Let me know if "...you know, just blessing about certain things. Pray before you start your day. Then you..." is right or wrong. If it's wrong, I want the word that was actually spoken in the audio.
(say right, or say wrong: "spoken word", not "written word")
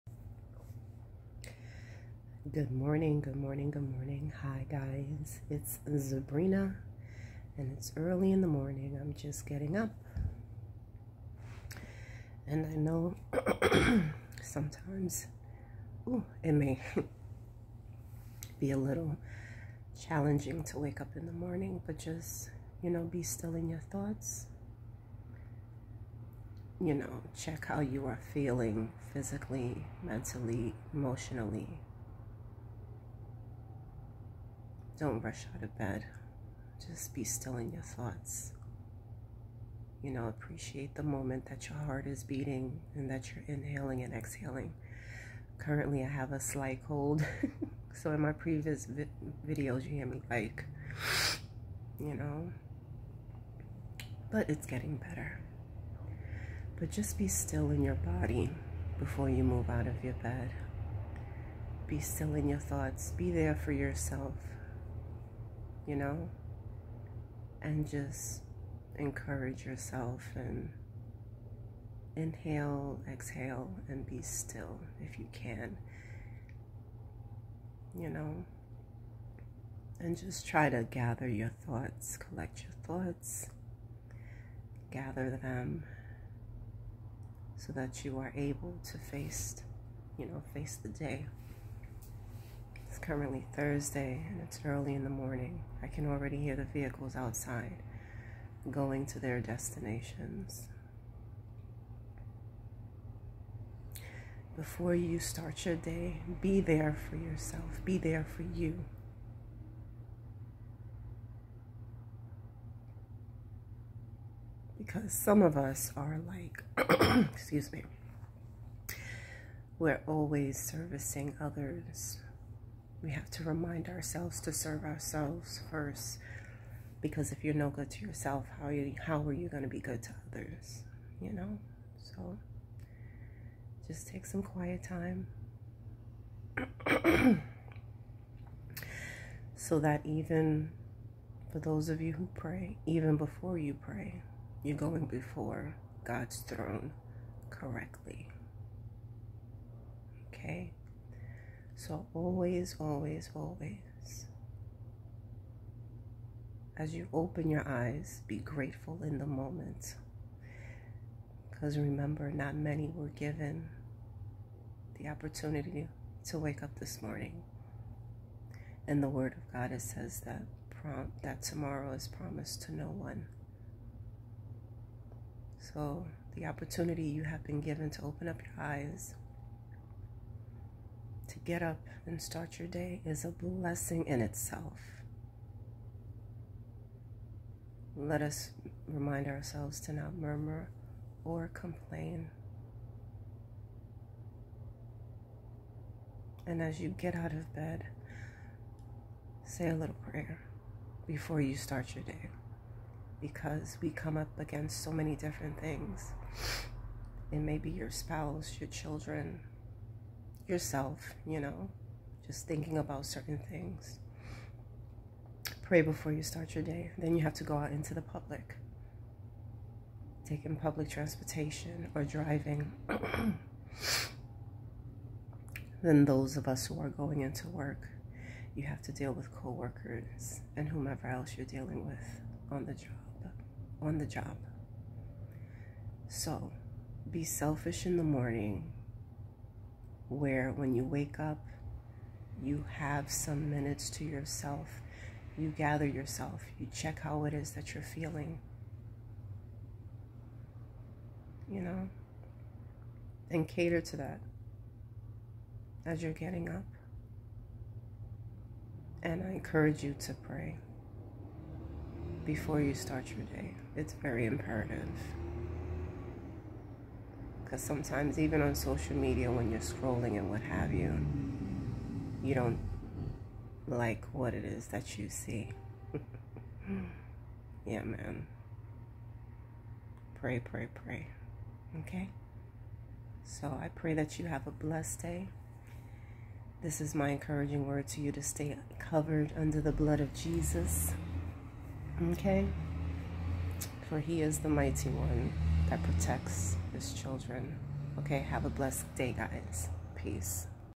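wrong: "thinking", not "blessing".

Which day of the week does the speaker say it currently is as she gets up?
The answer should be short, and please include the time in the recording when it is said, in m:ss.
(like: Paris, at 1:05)
Thursday, at 1:33.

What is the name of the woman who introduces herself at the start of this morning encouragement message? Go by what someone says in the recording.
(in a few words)
Sabrina.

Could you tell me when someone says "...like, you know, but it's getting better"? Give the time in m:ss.
0:50.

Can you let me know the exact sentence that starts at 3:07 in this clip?
Let us remind ourselves to not murmur or complain.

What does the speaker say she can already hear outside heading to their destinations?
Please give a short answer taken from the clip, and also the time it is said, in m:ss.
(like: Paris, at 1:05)
vehicles, at 1:36.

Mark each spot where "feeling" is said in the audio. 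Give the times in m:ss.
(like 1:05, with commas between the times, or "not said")
0:28, 4:07.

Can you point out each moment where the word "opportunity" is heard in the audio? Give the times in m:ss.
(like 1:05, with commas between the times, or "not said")
2:45, 2:56.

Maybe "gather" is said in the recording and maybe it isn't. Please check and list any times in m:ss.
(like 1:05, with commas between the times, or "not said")
1:20, 1:24, 4:05.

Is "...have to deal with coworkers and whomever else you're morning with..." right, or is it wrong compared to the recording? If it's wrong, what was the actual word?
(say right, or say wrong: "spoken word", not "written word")
wrong: "dealing", not "morning".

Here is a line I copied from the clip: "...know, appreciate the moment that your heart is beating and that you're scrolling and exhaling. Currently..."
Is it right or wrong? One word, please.
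wrong.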